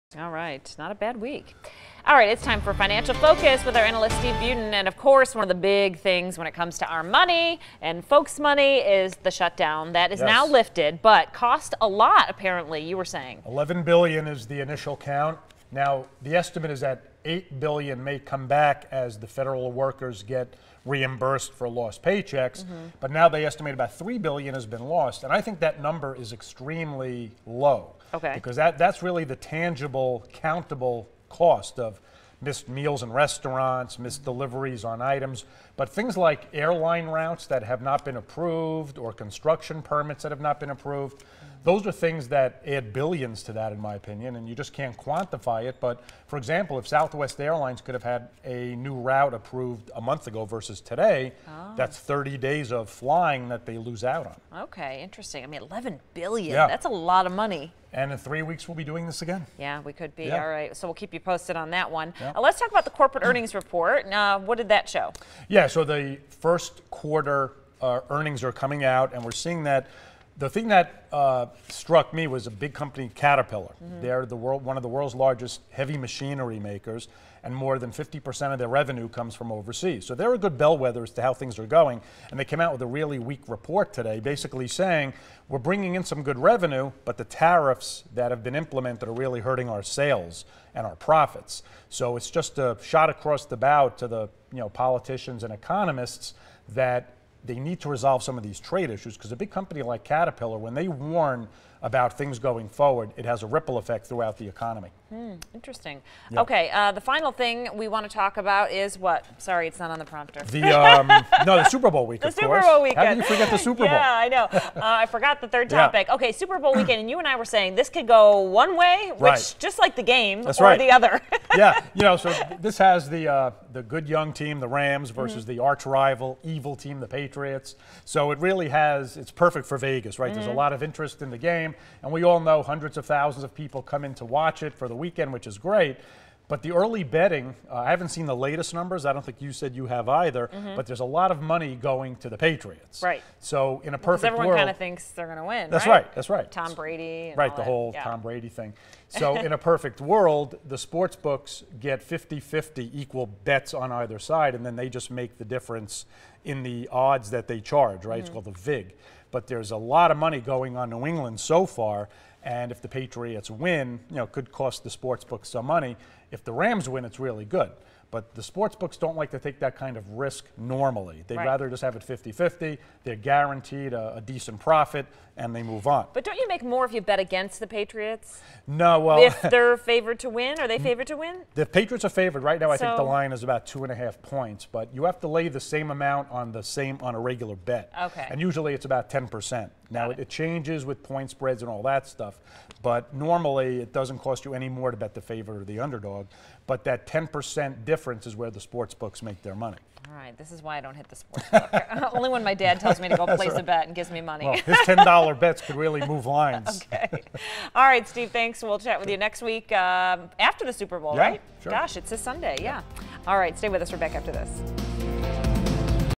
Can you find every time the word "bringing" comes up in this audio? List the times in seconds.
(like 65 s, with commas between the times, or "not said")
85 s.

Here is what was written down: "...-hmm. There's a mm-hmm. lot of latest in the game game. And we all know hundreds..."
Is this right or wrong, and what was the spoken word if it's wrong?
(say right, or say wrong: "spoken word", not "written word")
wrong: "interest", not "latest".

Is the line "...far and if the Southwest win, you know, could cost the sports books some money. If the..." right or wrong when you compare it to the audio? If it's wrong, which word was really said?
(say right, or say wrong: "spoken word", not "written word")
wrong: "Patriots", not "Southwest".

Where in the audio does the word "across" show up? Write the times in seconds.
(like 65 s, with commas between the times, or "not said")
93 s.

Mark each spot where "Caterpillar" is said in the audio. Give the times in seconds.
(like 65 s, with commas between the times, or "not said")
73 s, 100 s.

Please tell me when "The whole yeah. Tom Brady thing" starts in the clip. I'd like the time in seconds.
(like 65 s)
147 s.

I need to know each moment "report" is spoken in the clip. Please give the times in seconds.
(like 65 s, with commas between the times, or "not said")
63 s, 83 s.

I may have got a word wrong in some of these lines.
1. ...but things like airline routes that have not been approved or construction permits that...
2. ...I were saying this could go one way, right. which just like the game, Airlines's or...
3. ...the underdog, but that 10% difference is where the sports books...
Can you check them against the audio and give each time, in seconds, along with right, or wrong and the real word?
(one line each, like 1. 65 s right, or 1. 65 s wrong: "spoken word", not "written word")
1. 35 s right
2. 117 s wrong: "That", not "Airlines"
3. 195 s right.